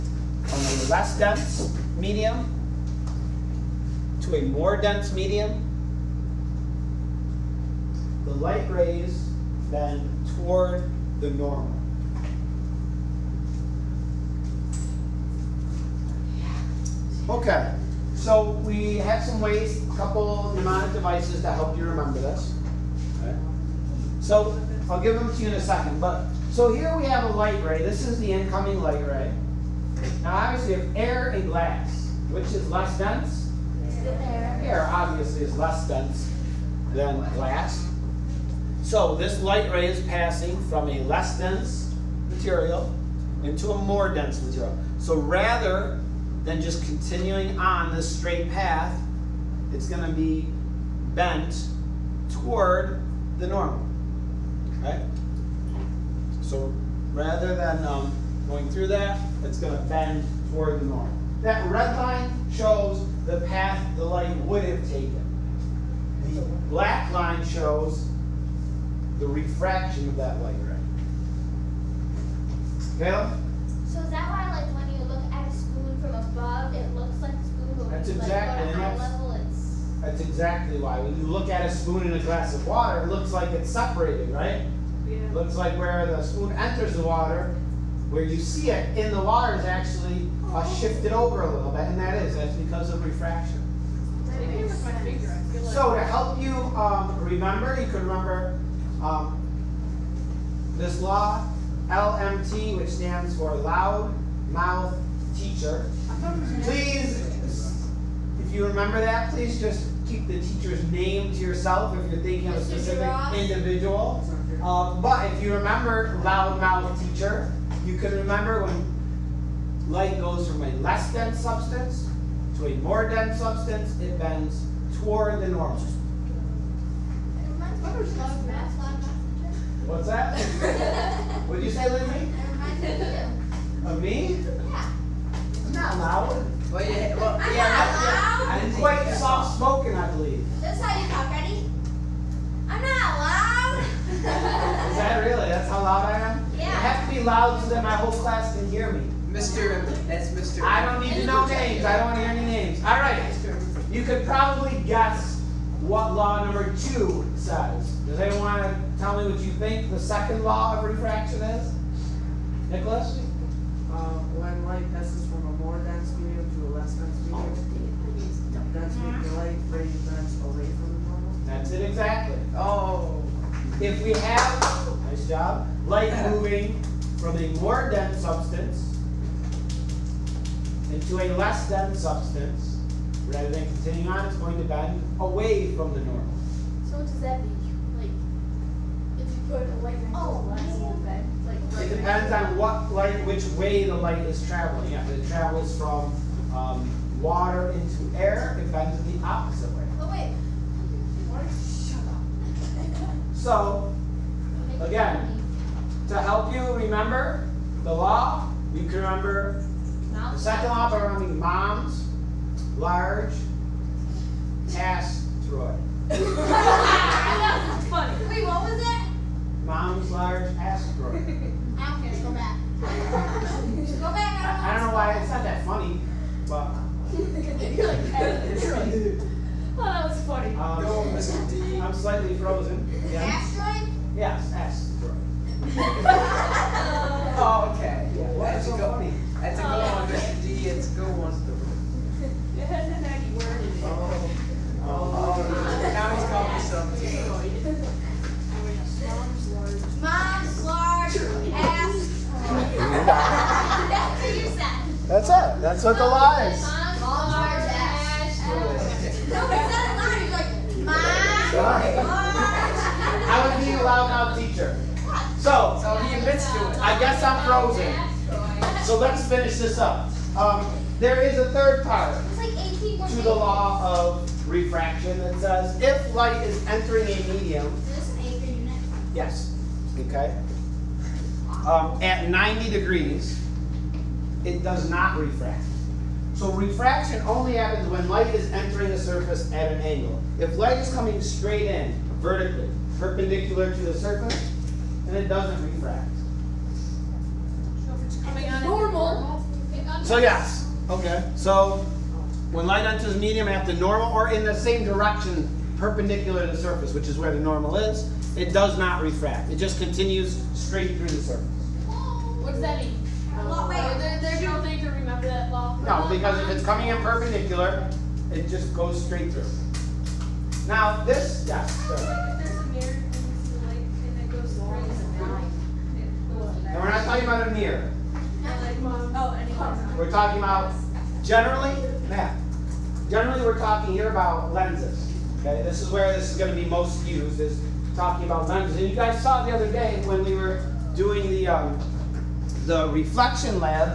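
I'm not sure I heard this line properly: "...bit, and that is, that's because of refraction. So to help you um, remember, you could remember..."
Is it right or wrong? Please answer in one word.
right.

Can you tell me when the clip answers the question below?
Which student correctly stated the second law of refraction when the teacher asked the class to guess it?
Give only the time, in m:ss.
2:42.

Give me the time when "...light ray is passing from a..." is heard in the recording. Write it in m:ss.
0:39.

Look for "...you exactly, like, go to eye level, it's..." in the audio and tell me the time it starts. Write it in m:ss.
1:18.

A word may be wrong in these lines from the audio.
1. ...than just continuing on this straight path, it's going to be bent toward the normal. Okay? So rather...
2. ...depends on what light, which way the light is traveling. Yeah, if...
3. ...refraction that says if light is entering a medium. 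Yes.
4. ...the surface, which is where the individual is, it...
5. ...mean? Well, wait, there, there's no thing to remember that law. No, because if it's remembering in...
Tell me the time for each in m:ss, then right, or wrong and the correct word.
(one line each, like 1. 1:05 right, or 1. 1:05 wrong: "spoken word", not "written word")
1. 0:46 right
2. 3:11 right
3. 4:34 right
4. 5:06 wrong: "normal", not "individual"
5. 5:12 wrong: "coming", not "remembering".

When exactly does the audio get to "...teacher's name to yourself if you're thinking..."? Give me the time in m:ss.
1:50.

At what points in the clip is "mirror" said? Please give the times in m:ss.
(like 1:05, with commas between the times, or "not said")
5:22, 5:27.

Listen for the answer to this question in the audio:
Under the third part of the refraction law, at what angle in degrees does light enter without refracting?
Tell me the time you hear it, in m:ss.
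4:42.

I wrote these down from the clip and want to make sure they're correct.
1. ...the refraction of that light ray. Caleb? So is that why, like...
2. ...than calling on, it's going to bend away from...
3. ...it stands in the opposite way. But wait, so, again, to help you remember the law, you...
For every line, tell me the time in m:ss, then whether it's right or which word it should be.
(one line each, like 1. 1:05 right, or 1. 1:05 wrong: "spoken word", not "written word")
1. 1:09 right
2. 3:03 wrong: "continuing", not "calling"
3. 3:18 wrong: "bends", not "stands".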